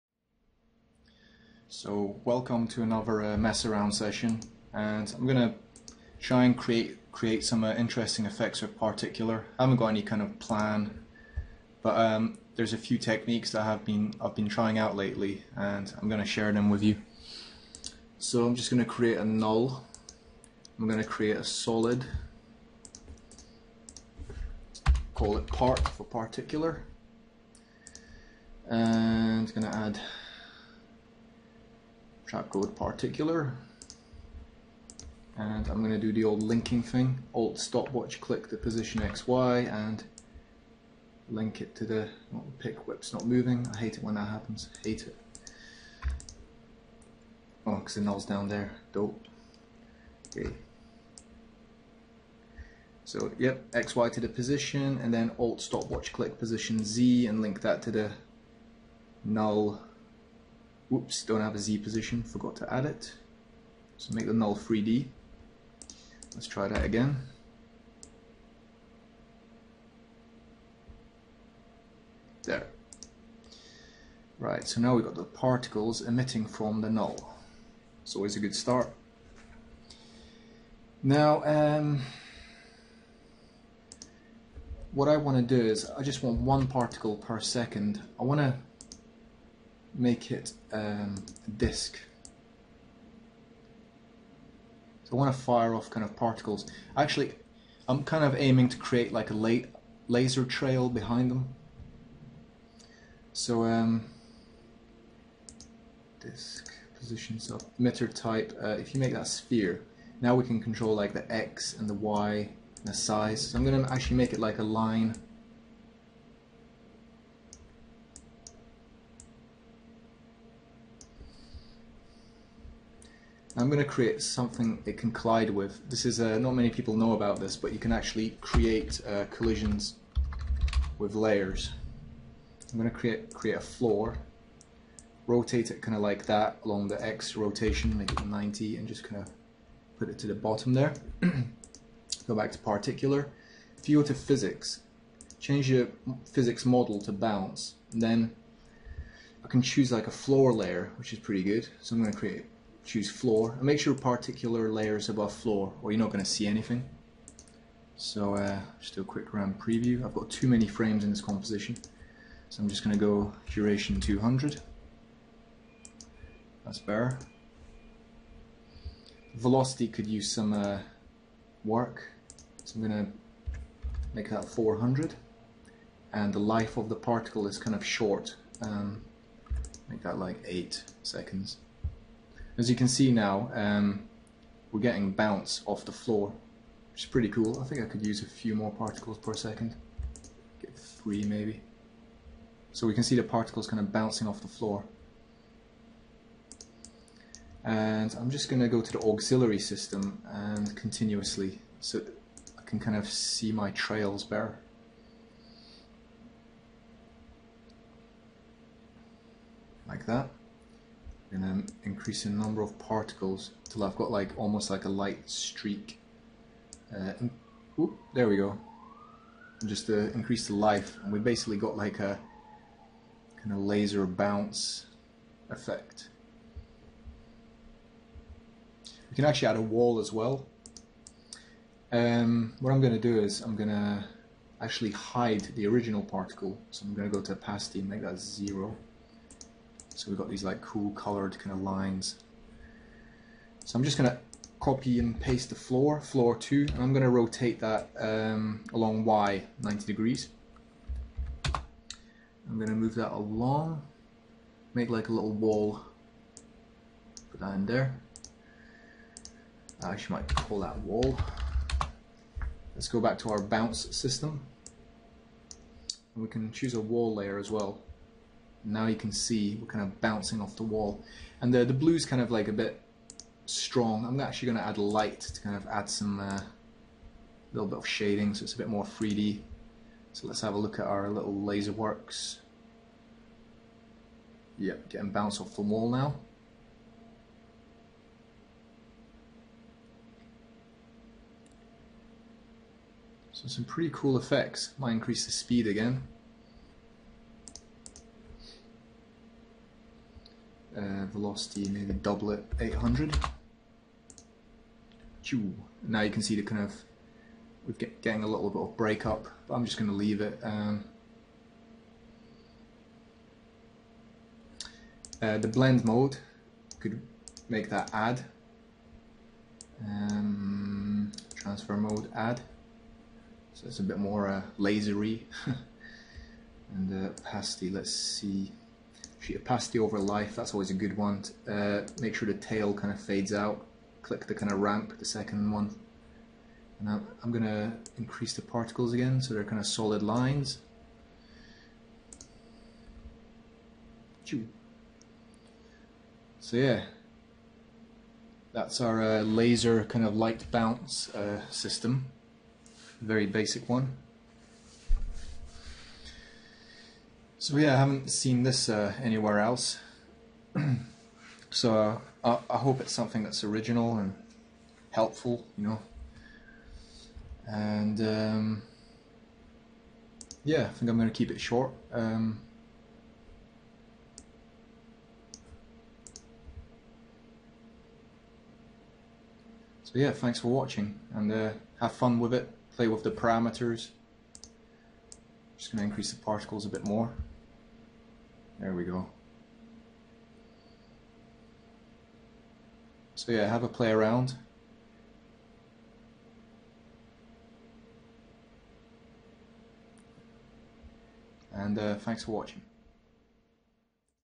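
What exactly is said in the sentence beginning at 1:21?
Now, um, what I want to do is I just want one particle per second.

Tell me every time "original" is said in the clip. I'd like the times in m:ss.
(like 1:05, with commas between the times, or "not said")
3:55, 6:03.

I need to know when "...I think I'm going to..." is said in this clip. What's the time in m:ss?
6:10.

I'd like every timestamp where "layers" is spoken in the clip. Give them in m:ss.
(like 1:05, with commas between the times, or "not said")
2:11, 2:30, 2:34, 4:27.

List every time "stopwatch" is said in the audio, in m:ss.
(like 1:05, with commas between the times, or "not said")
0:37, 0:55.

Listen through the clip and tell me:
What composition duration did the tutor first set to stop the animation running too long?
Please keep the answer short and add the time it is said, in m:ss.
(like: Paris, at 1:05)
200, at 2:43.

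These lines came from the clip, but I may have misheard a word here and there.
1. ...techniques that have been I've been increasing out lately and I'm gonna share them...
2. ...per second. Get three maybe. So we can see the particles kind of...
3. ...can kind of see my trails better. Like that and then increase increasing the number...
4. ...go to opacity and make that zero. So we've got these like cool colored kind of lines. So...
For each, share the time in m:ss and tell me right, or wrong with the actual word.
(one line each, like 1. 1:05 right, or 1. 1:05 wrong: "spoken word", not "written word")
1. 0:12 wrong: "trying", not "increasing"
2. 3:09 right
3. 3:22 right
4. 3:57 right.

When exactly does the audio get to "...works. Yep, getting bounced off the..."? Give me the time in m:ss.
4:41.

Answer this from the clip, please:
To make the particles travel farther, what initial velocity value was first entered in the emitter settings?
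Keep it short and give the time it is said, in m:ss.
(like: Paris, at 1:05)
400, at 2:54.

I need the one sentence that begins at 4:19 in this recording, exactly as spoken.
I actually might call that wall.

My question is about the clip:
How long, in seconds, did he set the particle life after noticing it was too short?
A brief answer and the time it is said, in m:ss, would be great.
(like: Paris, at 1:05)
8 seconds, at 3:00.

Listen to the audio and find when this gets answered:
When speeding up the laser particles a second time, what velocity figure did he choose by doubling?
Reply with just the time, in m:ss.
5:02.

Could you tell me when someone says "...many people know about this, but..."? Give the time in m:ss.
2:06.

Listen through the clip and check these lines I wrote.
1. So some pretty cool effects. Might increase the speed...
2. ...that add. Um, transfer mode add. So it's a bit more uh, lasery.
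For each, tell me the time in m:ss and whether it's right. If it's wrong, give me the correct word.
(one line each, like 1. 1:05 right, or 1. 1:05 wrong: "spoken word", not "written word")
1. 4:53 right
2. 5:17 right.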